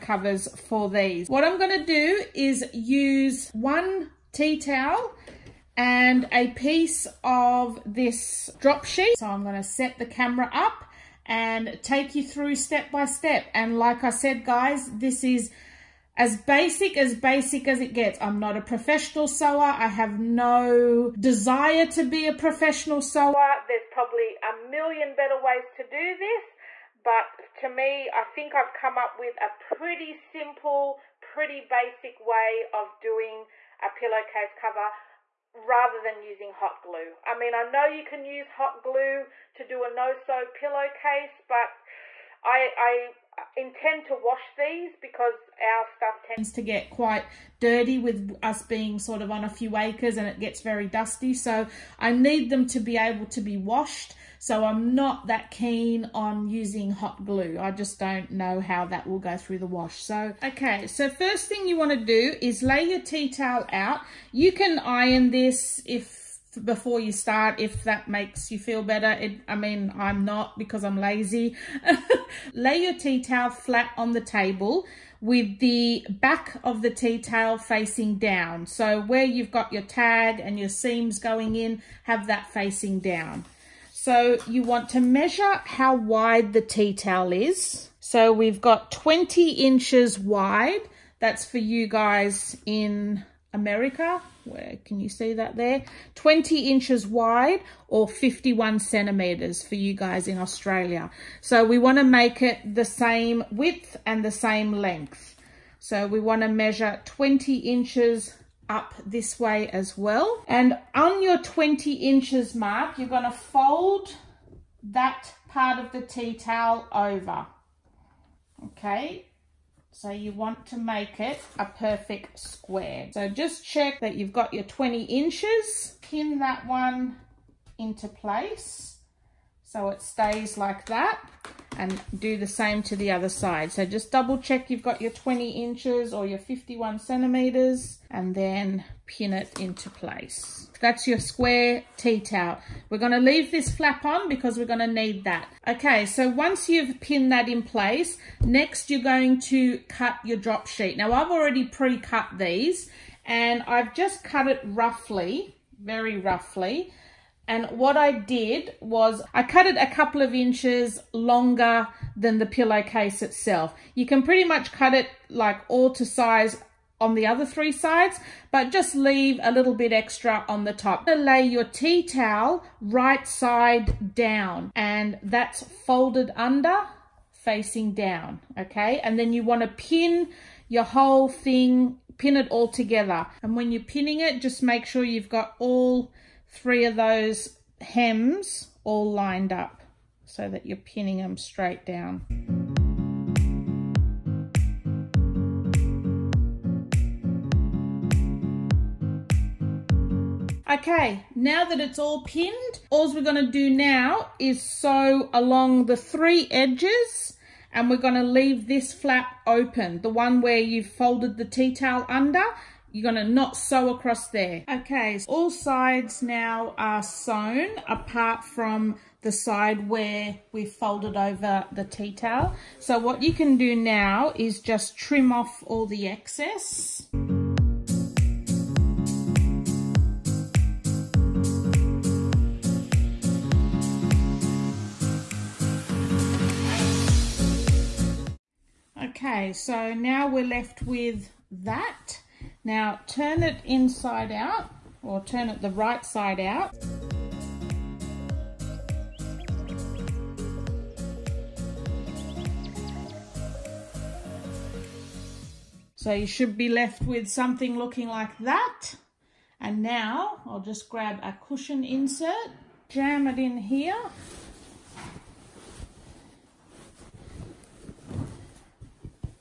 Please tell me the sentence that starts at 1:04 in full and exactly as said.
You can iron this if before you start if that makes you feel better.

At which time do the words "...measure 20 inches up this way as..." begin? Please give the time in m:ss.
1:46.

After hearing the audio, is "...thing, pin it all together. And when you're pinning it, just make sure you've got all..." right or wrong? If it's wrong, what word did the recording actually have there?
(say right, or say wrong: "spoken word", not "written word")
right.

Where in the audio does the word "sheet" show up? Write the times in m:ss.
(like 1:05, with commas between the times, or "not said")
0:08, 2:30.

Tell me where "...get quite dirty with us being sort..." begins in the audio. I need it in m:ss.
0:46.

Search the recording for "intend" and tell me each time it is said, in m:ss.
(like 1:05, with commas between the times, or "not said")
0:43.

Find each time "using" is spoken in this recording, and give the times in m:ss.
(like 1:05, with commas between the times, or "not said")
0:36, 0:56.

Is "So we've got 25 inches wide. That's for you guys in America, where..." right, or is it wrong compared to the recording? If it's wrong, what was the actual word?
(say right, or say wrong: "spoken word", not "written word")
wrong: "20", not "25".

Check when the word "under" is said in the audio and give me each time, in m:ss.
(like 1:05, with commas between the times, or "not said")
2:56, 3:32.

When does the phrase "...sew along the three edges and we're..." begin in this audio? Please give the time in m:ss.
3:24.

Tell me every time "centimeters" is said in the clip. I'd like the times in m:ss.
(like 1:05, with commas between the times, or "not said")
1:38, 2:16.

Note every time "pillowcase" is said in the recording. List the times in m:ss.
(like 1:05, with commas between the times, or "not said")
0:33, 0:40, 2:42.